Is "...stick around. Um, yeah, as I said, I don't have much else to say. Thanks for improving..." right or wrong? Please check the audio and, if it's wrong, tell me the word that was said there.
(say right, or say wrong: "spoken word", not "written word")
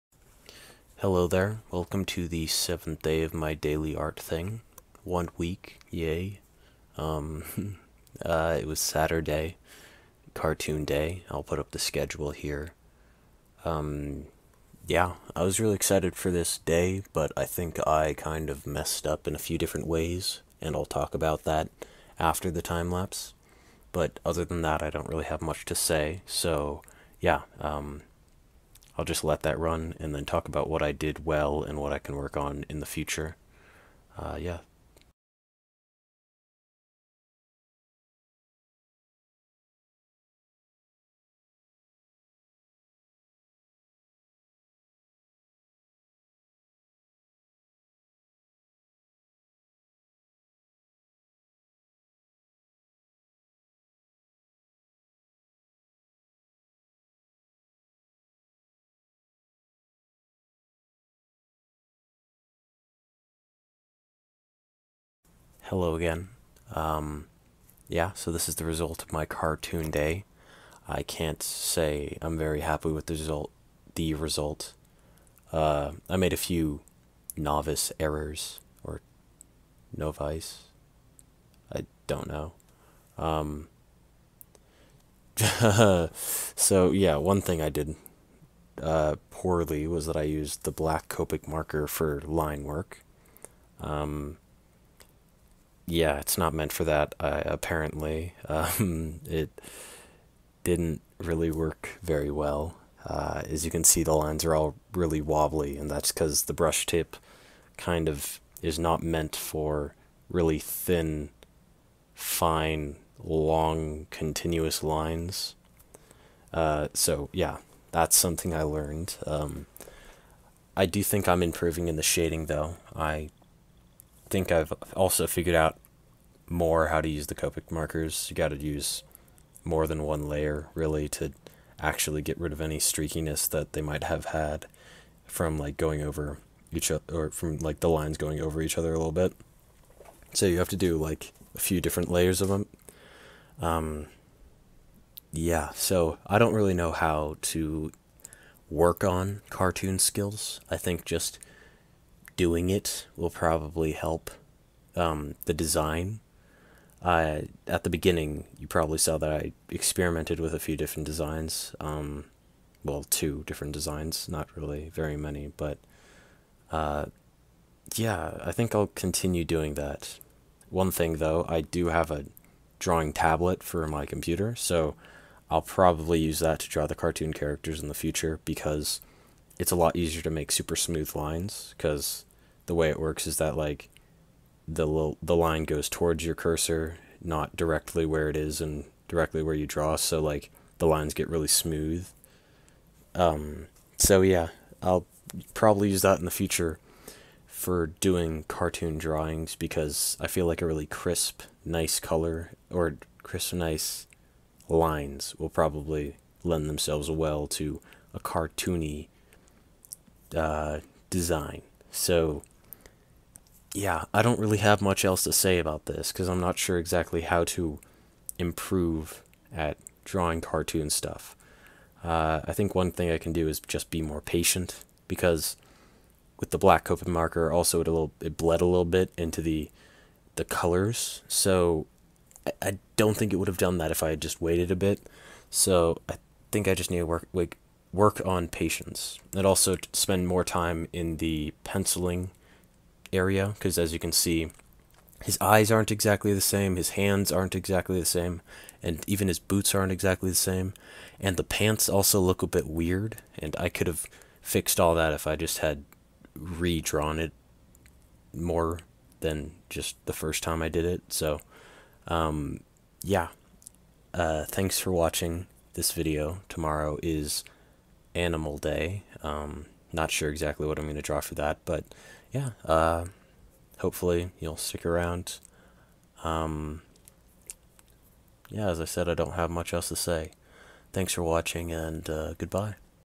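wrong: "watching", not "improving".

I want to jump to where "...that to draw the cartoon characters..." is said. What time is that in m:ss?
2:56.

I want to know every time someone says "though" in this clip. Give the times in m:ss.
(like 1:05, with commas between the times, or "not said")
2:02, 2:51.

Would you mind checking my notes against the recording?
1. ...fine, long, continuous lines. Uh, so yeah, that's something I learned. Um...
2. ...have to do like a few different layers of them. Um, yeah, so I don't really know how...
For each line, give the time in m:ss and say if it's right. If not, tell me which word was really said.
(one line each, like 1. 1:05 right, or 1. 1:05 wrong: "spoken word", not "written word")
1. 1:52 right
2. 2:20 right.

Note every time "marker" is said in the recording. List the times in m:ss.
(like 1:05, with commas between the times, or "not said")
1:31, 2:07, 3:47.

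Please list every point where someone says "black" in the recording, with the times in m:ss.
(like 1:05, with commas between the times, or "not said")
1:30, 3:46.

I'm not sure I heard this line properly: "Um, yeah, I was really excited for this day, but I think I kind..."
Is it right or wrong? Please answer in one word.
right.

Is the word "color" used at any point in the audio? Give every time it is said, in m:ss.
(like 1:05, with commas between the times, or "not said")
3:21, 3:50.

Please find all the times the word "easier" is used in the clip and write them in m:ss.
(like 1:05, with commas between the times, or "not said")
2:59.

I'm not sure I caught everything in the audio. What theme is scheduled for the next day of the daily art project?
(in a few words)
Animal Day.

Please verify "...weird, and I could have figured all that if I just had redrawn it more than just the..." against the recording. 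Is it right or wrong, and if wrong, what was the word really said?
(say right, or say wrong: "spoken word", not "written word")
wrong: "fixed", not "figured".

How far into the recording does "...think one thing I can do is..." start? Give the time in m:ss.
3:42.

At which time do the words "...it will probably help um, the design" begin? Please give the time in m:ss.
2:32.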